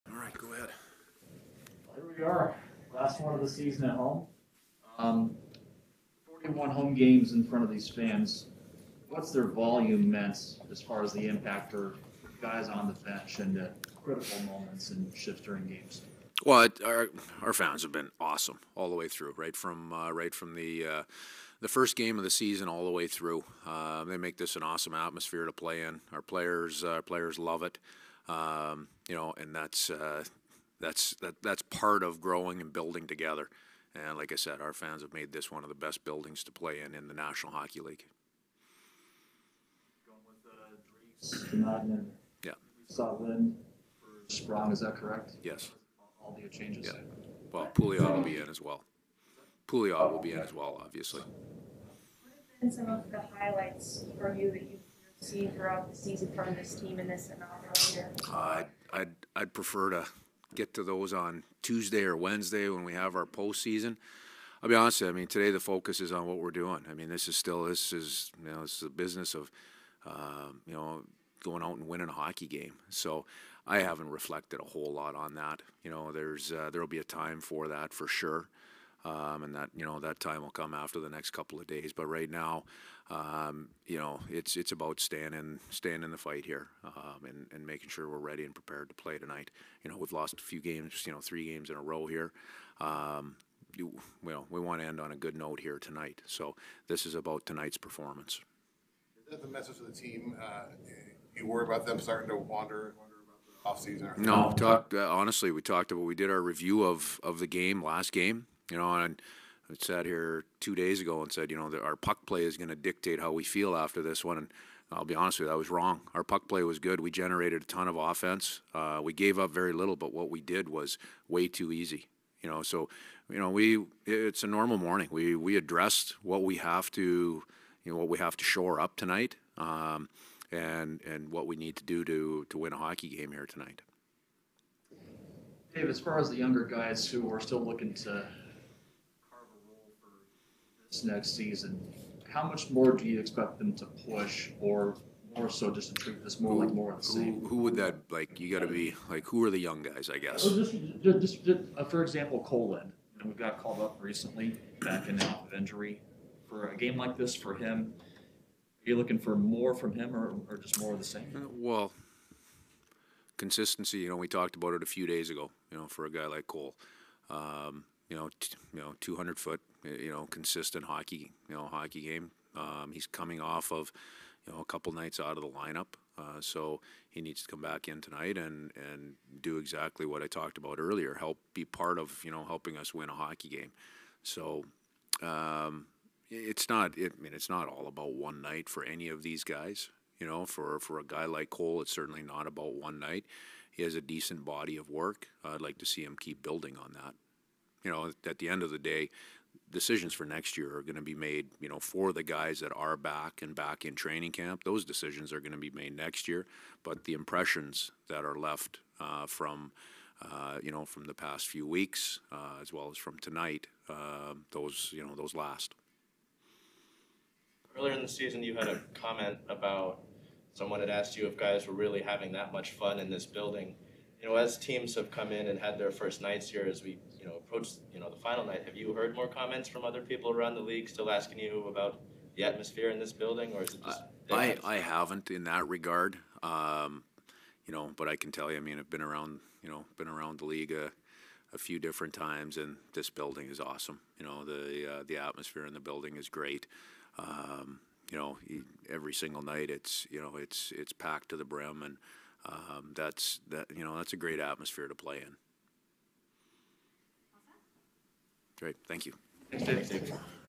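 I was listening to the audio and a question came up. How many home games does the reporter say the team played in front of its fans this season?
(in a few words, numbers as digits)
41.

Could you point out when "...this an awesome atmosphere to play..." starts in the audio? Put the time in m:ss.
0:24.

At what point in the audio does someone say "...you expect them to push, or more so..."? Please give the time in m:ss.
2:23.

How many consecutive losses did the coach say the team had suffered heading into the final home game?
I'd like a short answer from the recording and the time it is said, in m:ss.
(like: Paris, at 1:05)
3, at 1:31.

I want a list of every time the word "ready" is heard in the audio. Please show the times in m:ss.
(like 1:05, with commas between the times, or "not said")
1:28.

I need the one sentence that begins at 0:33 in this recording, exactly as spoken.
And like I said, our fans have made this one of the best buildings to play in in the National Hockey League.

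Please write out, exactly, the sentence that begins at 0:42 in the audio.
Saw Lind Sprong, is that correct?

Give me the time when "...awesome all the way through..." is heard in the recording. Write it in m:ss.
0:18.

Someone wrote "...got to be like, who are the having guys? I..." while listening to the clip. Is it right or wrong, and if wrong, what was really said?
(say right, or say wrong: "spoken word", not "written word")
wrong: "young", not "having".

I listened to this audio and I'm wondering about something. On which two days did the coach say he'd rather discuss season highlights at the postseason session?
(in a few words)
Tuesday or Wednesday.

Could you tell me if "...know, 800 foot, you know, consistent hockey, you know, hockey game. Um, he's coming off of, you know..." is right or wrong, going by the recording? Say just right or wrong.
wrong.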